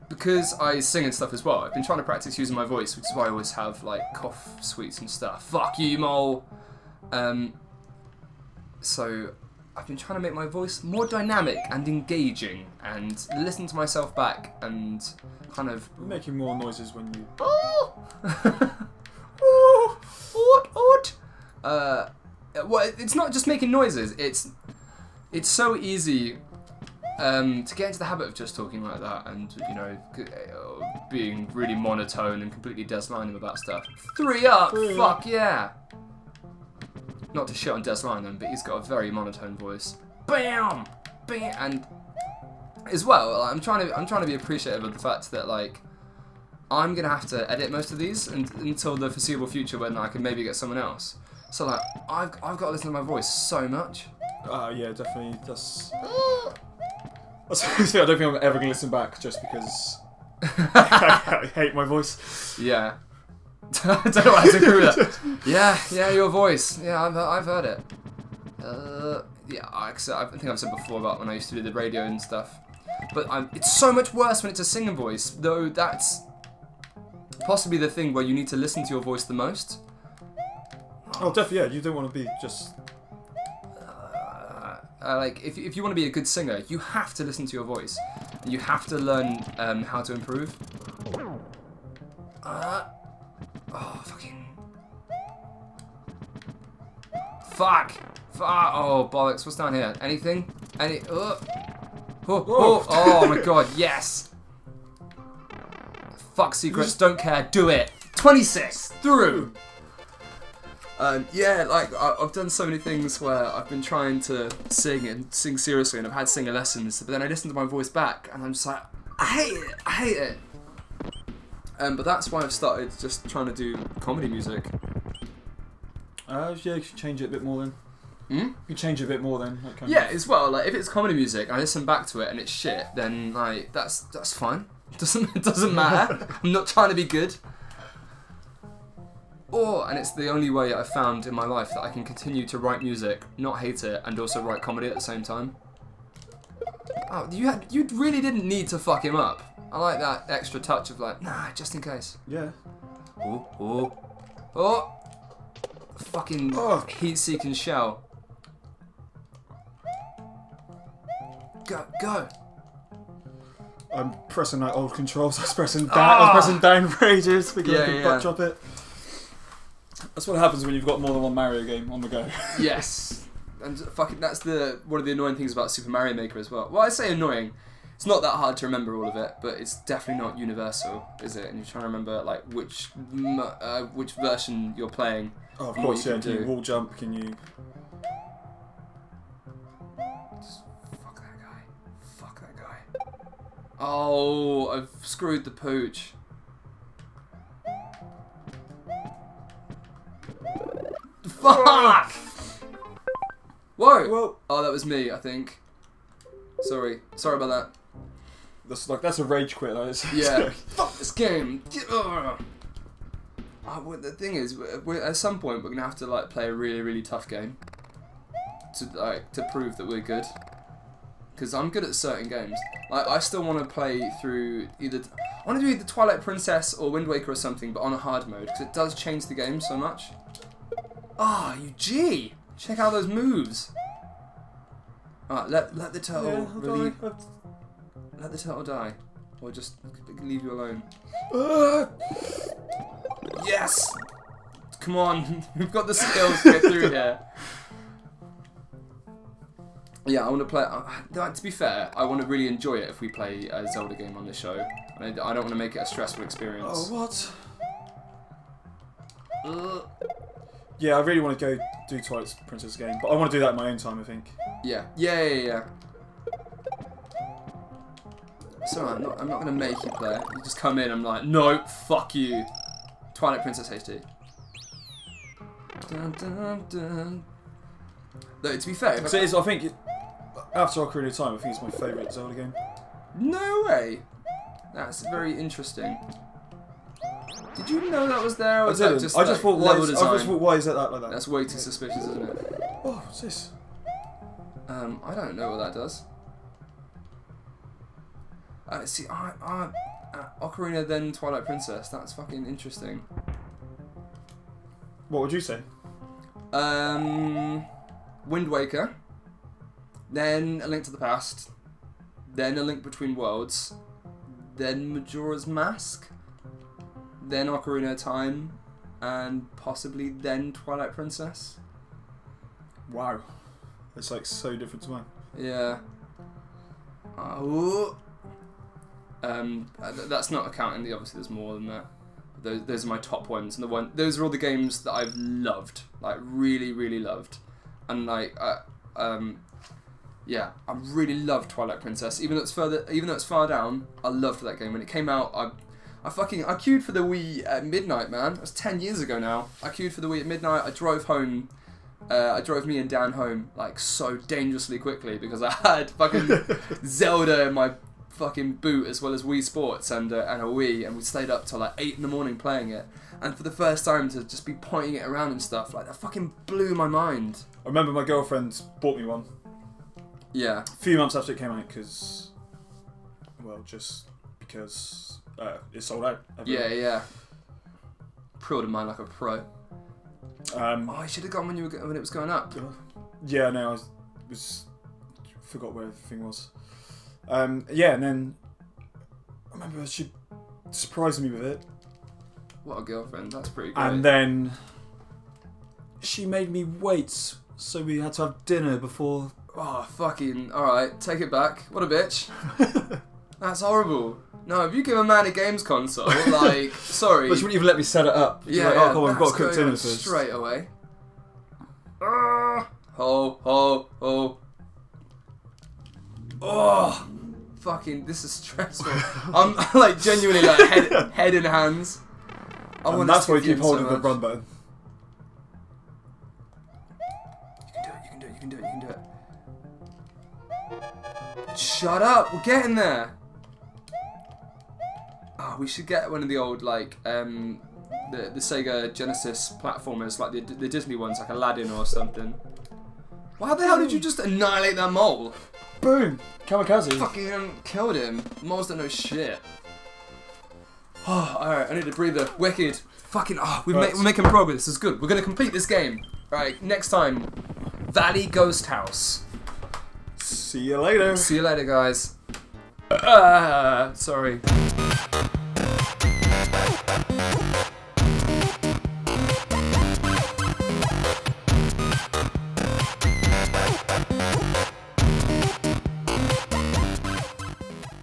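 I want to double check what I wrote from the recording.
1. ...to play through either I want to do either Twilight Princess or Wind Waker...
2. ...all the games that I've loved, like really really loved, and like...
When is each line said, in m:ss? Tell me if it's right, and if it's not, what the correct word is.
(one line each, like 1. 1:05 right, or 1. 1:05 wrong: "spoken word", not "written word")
1. 3:43 right
2. 5:34 right.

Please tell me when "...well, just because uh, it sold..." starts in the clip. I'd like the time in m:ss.
6:13.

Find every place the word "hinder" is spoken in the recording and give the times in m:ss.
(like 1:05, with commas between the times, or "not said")
not said.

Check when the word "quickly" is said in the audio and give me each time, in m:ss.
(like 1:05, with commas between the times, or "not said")
5:54.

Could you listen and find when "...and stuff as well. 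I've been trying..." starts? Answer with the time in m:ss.
0:01.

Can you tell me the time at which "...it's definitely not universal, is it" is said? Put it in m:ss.
2:59.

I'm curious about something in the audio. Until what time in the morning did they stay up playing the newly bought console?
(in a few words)
8.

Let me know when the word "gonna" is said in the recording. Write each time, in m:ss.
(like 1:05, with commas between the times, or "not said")
0:46, 0:58, 3:35.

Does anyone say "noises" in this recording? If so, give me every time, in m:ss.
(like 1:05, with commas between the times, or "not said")
0:16, 0:23.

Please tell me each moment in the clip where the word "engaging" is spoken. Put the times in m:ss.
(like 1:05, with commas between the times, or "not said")
0:11.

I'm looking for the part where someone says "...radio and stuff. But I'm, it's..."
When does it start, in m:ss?
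1:11.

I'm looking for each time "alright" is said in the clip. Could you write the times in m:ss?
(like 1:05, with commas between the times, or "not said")
3:55, 4:28, 7:31, 7:36.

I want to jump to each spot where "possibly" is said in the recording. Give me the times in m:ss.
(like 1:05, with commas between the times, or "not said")
1:17, 5:19.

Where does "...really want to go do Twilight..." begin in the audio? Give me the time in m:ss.
4:20.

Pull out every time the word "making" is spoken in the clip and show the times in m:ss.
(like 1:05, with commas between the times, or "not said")
0:15, 0:23, 7:34.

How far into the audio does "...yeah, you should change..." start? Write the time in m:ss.
2:06.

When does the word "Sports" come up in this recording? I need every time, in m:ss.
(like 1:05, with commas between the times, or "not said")
5:59.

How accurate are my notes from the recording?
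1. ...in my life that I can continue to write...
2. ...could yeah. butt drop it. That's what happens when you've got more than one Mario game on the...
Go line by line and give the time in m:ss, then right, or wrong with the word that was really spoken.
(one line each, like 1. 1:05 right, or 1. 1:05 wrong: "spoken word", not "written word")
1. 2:21 right
2. 2:47 right.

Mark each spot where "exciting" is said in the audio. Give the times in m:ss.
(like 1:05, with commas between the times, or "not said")
not said.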